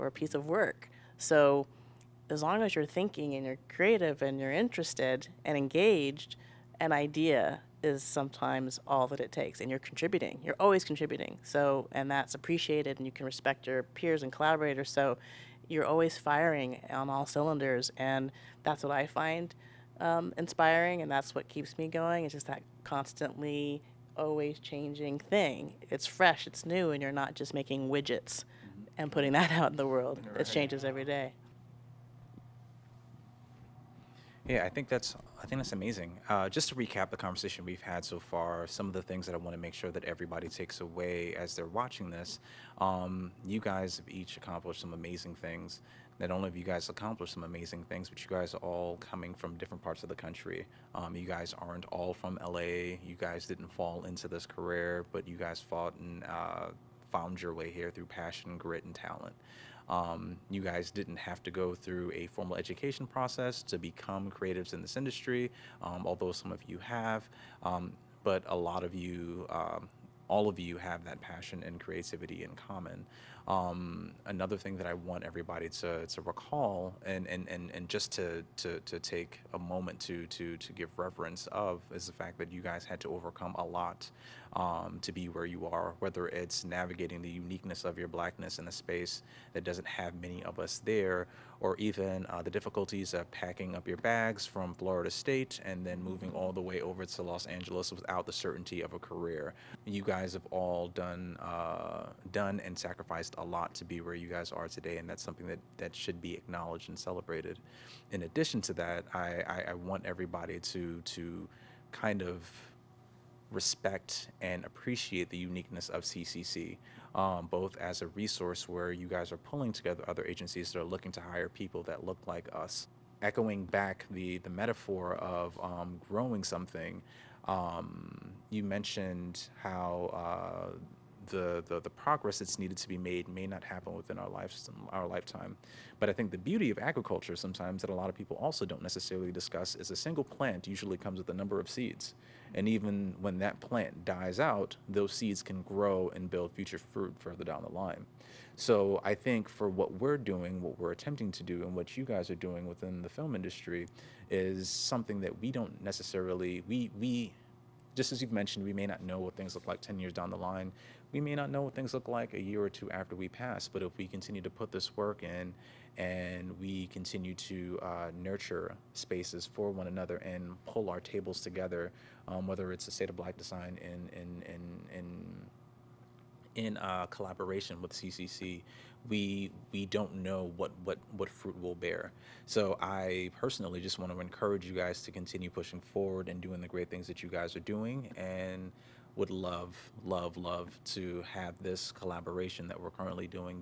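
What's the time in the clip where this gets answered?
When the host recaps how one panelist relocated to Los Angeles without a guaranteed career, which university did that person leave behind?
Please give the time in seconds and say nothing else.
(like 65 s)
94 s.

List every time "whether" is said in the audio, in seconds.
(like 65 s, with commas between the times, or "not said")
85 s, 172 s.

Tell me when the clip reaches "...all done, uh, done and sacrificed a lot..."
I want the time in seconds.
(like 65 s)
100 s.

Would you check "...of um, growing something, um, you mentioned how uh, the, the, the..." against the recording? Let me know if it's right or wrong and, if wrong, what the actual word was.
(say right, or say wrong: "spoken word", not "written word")
right.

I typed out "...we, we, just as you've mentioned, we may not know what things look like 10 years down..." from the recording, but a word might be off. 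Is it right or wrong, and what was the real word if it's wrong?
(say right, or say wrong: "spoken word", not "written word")
right.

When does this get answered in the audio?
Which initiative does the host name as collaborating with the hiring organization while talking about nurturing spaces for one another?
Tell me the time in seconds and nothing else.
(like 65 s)
172 s.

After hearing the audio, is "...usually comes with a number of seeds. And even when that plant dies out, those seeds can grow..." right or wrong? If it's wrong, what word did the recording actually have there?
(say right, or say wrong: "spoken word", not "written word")
right.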